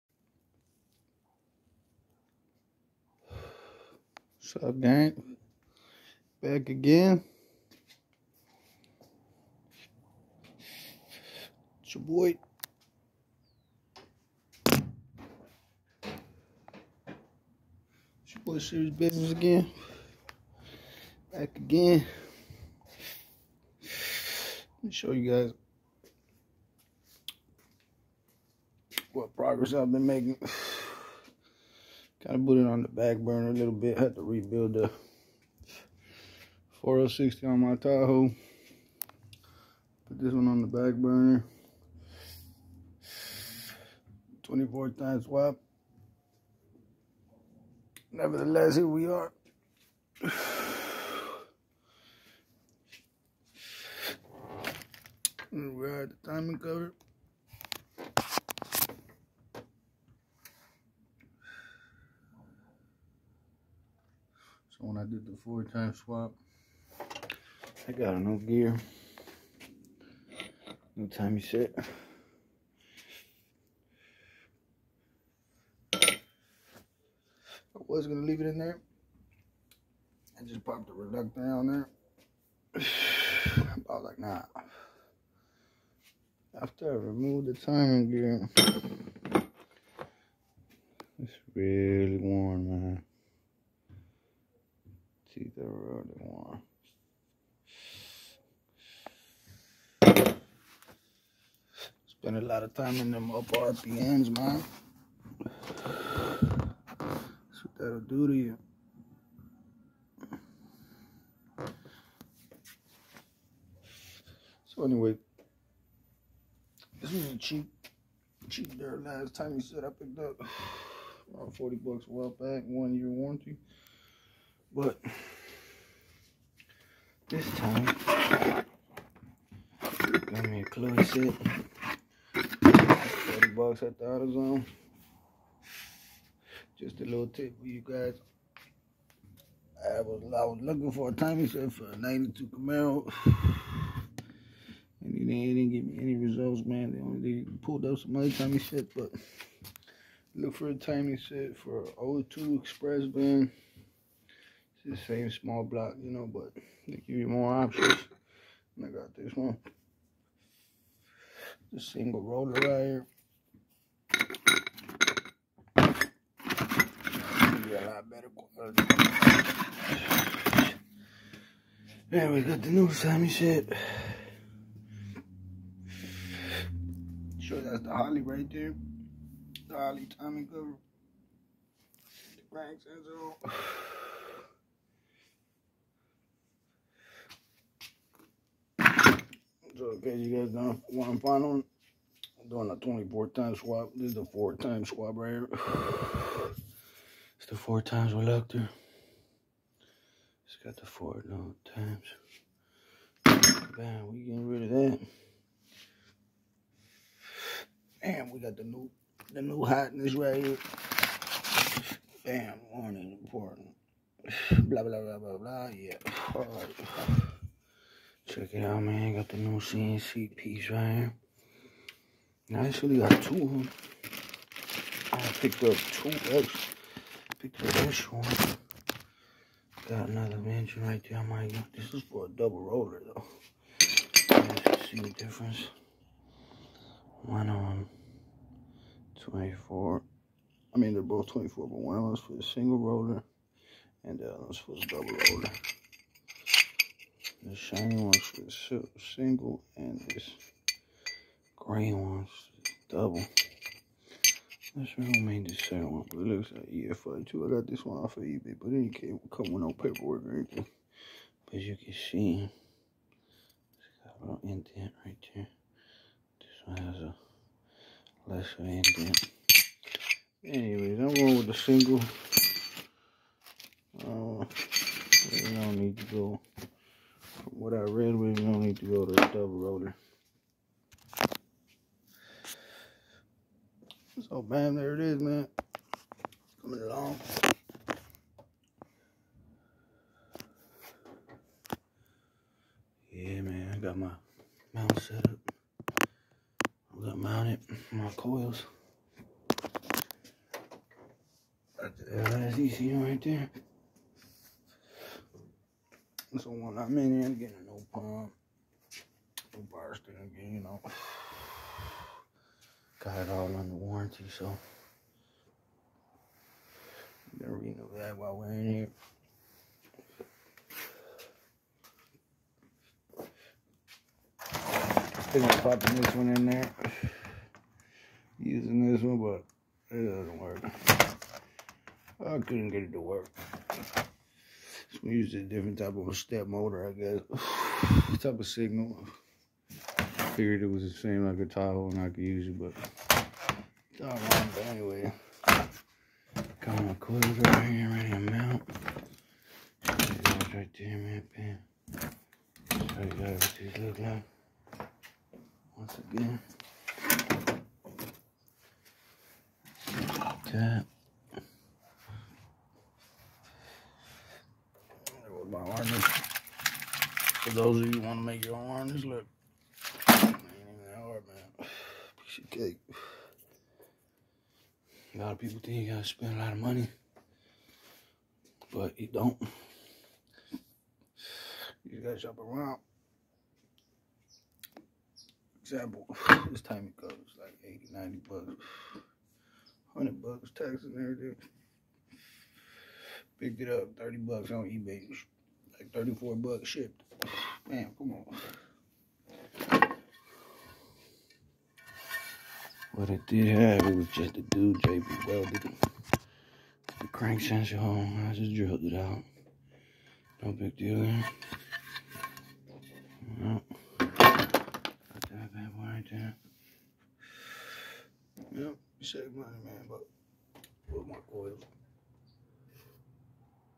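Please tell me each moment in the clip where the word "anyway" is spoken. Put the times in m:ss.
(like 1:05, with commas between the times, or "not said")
1:54, 4:30, 5:44.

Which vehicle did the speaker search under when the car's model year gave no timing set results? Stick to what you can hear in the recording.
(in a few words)
02 Express van.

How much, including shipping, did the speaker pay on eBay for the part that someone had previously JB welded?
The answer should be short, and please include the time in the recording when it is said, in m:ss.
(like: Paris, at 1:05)
34 bucks, at 6:35.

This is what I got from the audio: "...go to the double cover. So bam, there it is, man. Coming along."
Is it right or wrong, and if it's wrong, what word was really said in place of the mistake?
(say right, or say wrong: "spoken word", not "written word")
wrong: "roller", not "cover".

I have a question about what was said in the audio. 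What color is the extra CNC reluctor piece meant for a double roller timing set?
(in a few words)
green.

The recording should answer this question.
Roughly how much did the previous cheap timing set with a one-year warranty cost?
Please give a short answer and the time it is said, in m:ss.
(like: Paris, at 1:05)
40 bucks, at 2:01.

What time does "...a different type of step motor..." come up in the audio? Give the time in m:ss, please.
5:35.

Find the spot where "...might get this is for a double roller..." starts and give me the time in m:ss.
3:51.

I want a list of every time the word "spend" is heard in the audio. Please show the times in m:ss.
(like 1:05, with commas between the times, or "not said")
1:42, 6:16.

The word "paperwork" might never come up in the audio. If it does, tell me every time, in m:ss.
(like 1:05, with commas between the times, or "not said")
4:19.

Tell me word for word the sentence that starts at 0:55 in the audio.
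we are at the timing cover.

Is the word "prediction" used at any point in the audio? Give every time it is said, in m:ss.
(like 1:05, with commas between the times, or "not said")
not said.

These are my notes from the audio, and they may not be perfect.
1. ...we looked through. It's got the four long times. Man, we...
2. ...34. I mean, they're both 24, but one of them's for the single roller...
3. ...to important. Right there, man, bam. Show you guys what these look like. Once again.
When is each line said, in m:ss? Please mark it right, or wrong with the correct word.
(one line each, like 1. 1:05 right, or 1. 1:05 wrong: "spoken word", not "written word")
1. 3:18 right
2. 3:59 wrong: "24", not "34"
3. 5:48 wrong: "mount", not "important".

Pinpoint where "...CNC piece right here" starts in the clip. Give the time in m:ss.
3:39.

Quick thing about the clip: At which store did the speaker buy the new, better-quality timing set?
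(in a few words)
AutoZone.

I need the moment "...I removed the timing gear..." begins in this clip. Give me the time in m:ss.
1:26.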